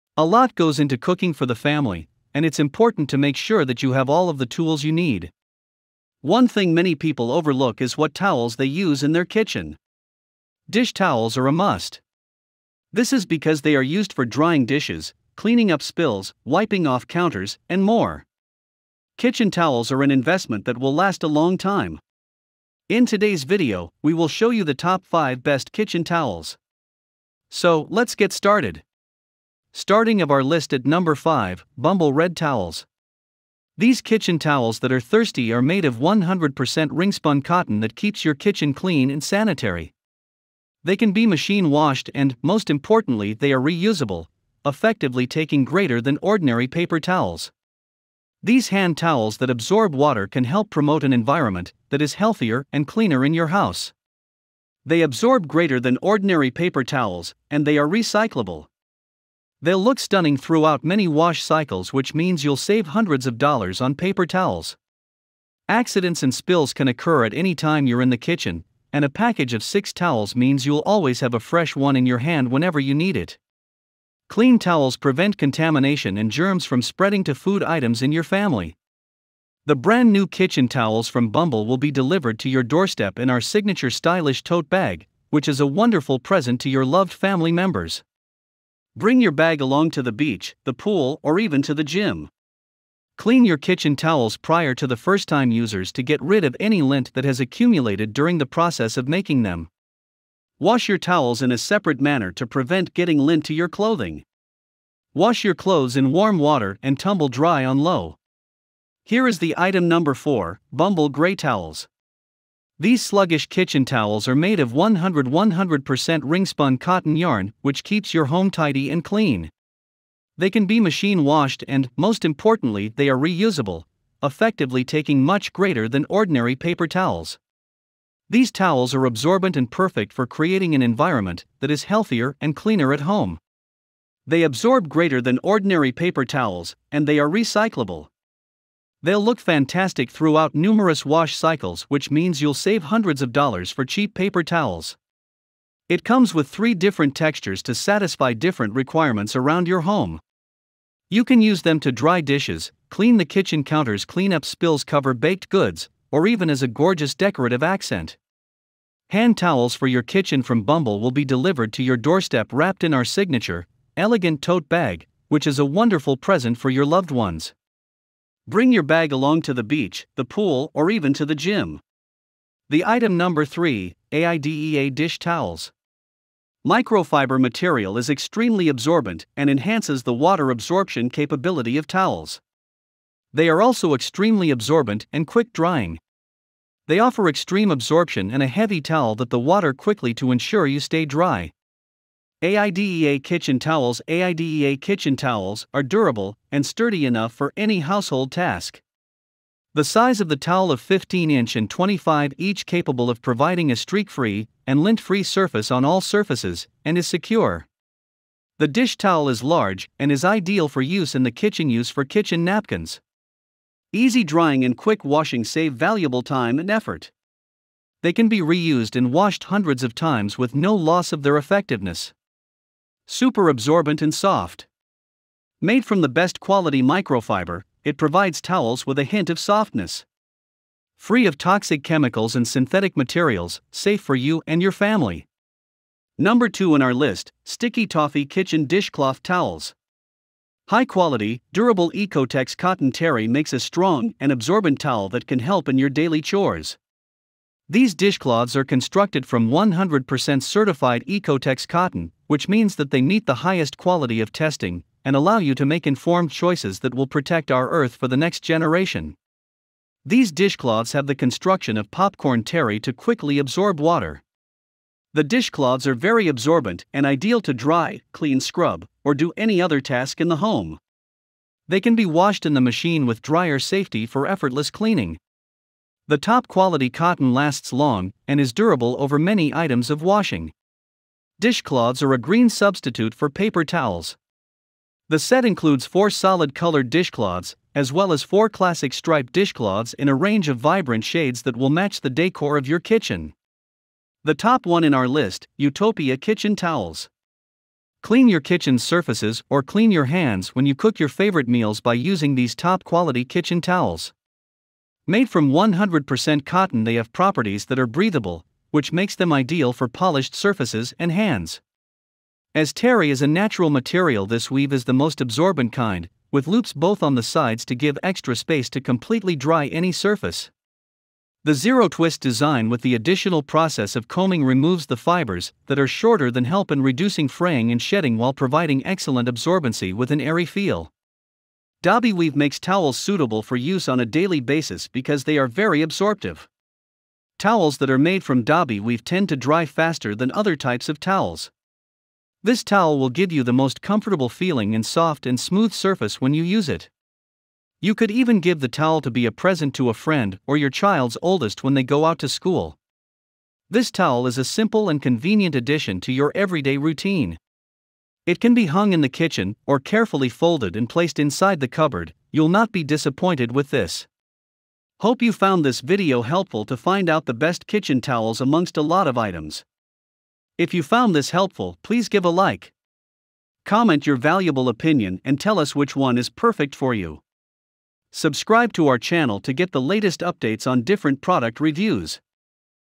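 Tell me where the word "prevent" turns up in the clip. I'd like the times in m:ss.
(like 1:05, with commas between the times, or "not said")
1:14, 1:42.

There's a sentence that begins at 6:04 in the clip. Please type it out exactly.
Hope you found this video helpful to find out the best kitchen towels amongst a lot of items.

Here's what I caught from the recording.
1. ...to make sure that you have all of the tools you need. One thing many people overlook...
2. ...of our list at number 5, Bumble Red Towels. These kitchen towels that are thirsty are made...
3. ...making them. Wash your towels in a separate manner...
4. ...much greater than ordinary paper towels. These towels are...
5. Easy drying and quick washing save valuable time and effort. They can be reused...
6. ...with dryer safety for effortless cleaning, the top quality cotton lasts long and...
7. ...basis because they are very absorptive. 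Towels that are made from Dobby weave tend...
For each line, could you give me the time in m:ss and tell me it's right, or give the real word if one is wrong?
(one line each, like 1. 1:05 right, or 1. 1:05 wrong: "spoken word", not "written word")
1. 0:03 right
2. 0:30 right
3. 1:39 right
4. 2:05 right
5. 3:33 right
6. 4:33 right
7. 5:34 right.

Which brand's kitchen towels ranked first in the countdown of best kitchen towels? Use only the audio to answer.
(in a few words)
Utopia.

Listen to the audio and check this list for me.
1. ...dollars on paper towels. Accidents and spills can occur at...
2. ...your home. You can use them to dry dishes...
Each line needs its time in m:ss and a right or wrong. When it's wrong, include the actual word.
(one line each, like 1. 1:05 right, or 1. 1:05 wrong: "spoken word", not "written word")
1. 1:03 right
2. 2:29 right.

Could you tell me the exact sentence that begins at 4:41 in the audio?
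Dishcloths are a green substitute for paper towels.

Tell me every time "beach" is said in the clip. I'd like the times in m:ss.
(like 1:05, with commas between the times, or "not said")
1:30, 2:49.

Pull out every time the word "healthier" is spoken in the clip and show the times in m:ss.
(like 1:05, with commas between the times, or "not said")
0:52, 2:11.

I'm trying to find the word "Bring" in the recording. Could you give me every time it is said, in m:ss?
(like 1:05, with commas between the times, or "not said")
1:28, 2:48.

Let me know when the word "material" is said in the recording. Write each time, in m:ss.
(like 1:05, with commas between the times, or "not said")
2:57, 3:52, 5:13.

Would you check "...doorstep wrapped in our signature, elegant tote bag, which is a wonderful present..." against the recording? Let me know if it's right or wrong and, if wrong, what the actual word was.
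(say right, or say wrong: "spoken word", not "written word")
right.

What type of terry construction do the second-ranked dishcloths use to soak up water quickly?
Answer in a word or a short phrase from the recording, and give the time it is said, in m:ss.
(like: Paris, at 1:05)
Popcorn terry, at 4:21.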